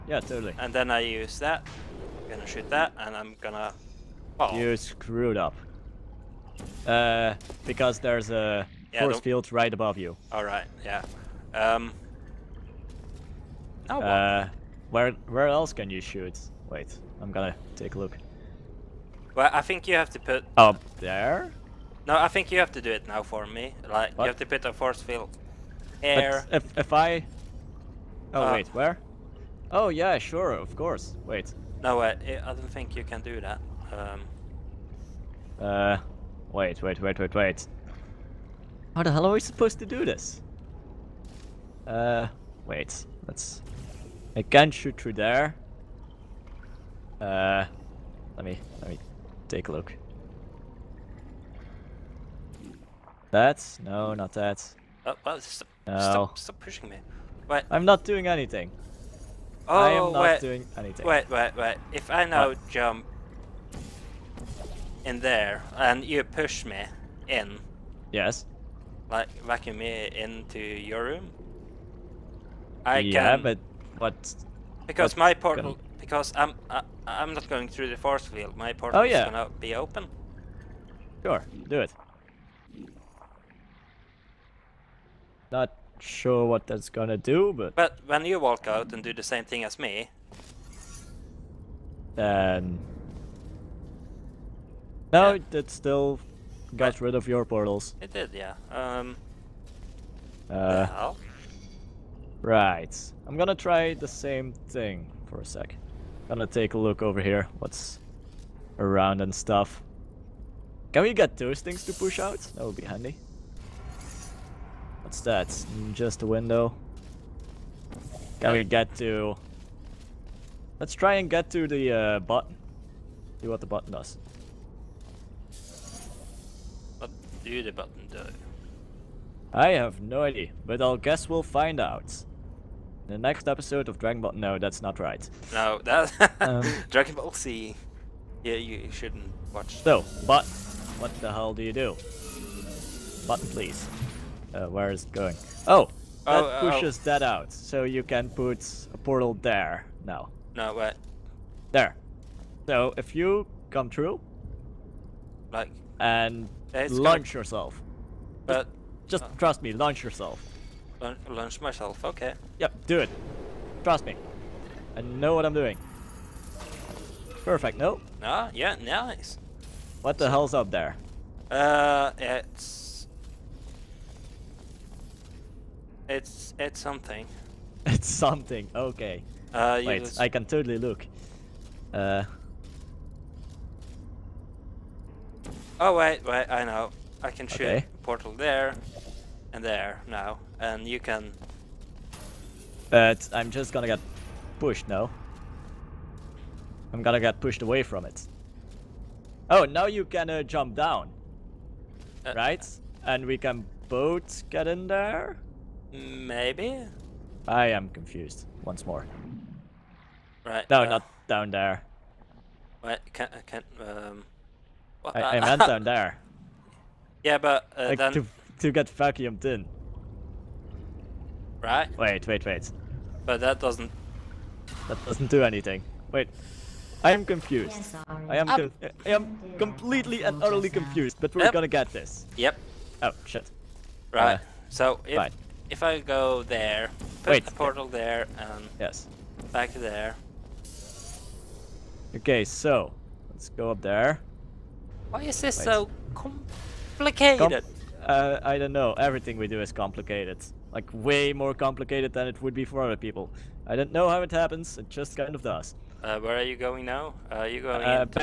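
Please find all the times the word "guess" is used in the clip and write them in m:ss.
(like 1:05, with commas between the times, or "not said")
2:10.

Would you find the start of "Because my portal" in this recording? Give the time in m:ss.
1:14.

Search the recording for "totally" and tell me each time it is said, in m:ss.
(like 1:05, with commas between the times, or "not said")
0:00, 3:00.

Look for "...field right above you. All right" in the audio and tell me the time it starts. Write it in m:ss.
0:09.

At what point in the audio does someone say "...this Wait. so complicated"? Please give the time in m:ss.
4:05.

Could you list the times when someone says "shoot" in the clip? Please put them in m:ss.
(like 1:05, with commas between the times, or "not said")
0:02, 0:16, 0:44, 3:07.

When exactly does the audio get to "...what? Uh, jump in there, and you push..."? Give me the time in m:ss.
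1:02.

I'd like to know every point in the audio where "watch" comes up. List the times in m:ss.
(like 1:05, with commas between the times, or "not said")
2:19.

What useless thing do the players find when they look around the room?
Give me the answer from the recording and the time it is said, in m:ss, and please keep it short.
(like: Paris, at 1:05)
window, at 1:56.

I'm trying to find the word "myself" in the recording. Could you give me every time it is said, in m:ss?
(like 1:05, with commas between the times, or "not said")
2:41.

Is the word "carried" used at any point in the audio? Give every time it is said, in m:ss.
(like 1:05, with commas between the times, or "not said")
not said.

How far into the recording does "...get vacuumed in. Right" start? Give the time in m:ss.
3:38.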